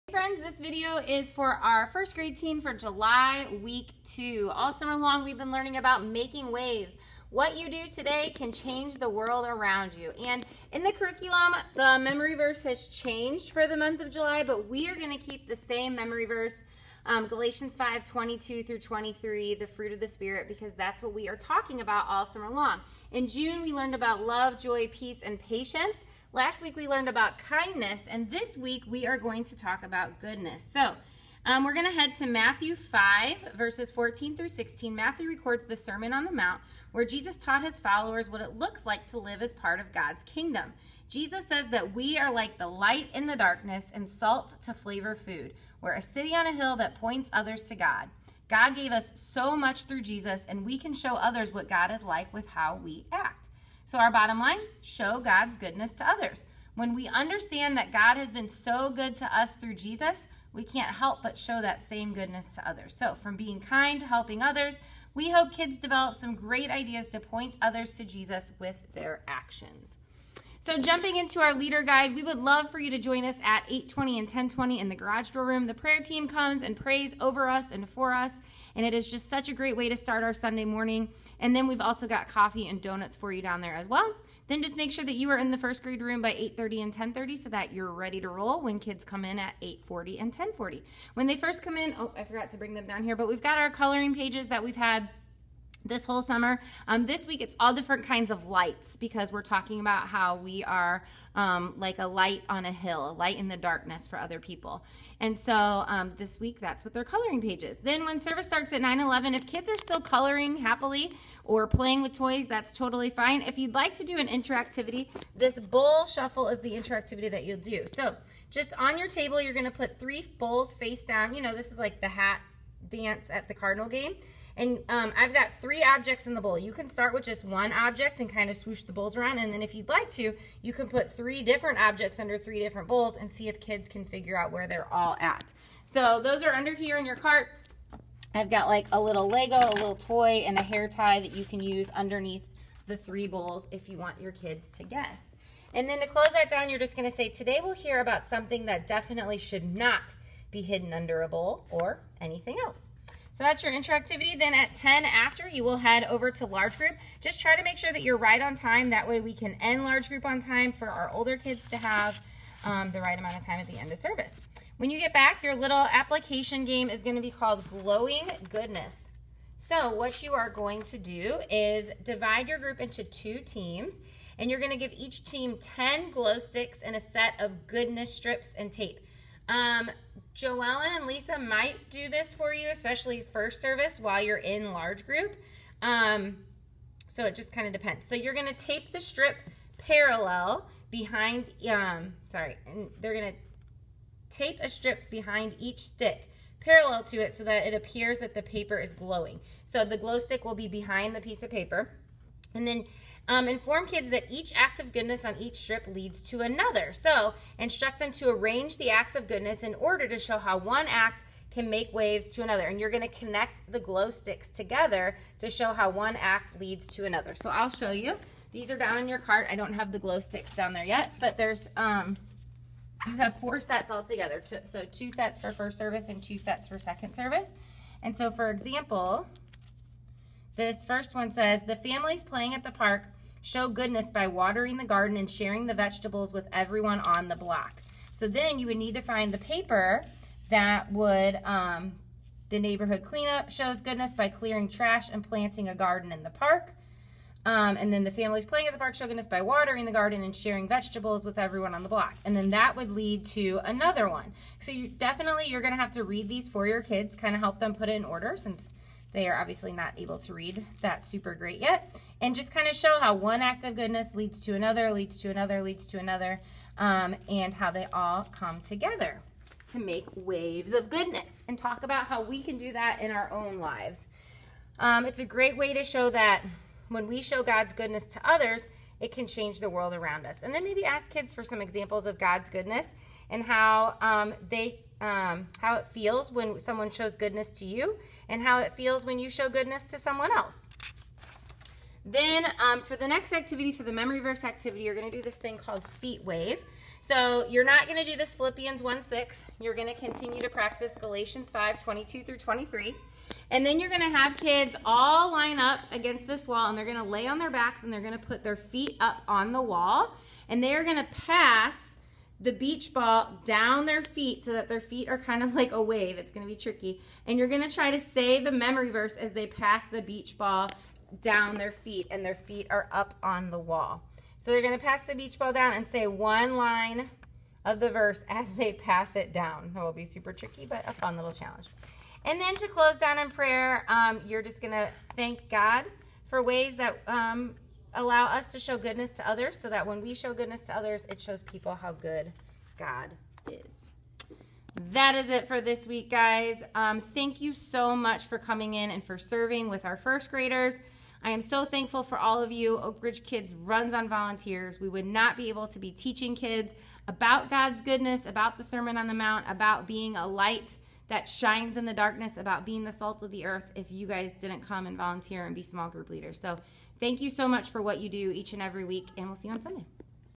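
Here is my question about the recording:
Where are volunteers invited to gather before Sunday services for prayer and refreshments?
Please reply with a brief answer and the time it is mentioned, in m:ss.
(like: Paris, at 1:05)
garage door room, at 1:14.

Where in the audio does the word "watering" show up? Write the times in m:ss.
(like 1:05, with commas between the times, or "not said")
3:54, 4:09.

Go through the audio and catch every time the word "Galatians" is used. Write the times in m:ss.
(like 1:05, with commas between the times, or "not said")
0:17, 5:00.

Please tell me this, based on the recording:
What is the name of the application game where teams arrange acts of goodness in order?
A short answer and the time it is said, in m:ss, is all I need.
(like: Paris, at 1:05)
Glowing Goodness, at 2:47.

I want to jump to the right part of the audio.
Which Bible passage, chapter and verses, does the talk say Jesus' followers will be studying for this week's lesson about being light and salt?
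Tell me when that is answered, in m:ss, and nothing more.
0:32.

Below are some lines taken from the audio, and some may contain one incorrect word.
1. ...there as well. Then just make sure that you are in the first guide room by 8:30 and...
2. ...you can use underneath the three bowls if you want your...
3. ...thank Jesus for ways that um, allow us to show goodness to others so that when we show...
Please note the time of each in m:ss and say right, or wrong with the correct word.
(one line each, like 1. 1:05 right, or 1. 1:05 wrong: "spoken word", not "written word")
1. 1:23 wrong: "grade", not "guide"
2. 2:21 right
3. 5:35 wrong: "God", not "Jesus".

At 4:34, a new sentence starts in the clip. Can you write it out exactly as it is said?
Um, it's a great way to show that when we show God's goodness to others, it can change the world around us.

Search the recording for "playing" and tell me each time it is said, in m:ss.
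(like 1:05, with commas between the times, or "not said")
1:51, 3:52, 4:08.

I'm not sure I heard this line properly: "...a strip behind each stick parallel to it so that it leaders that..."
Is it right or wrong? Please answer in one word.
wrong.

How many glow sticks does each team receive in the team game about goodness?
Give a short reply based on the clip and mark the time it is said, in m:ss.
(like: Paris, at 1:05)
10, at 2:55.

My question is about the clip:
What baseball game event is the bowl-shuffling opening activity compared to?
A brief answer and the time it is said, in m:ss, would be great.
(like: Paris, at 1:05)
hat dance, at 2:02.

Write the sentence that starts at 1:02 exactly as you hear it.
So, from being kind to helping others, we hope kids develop some great ideas to point others to Jesus with their actions.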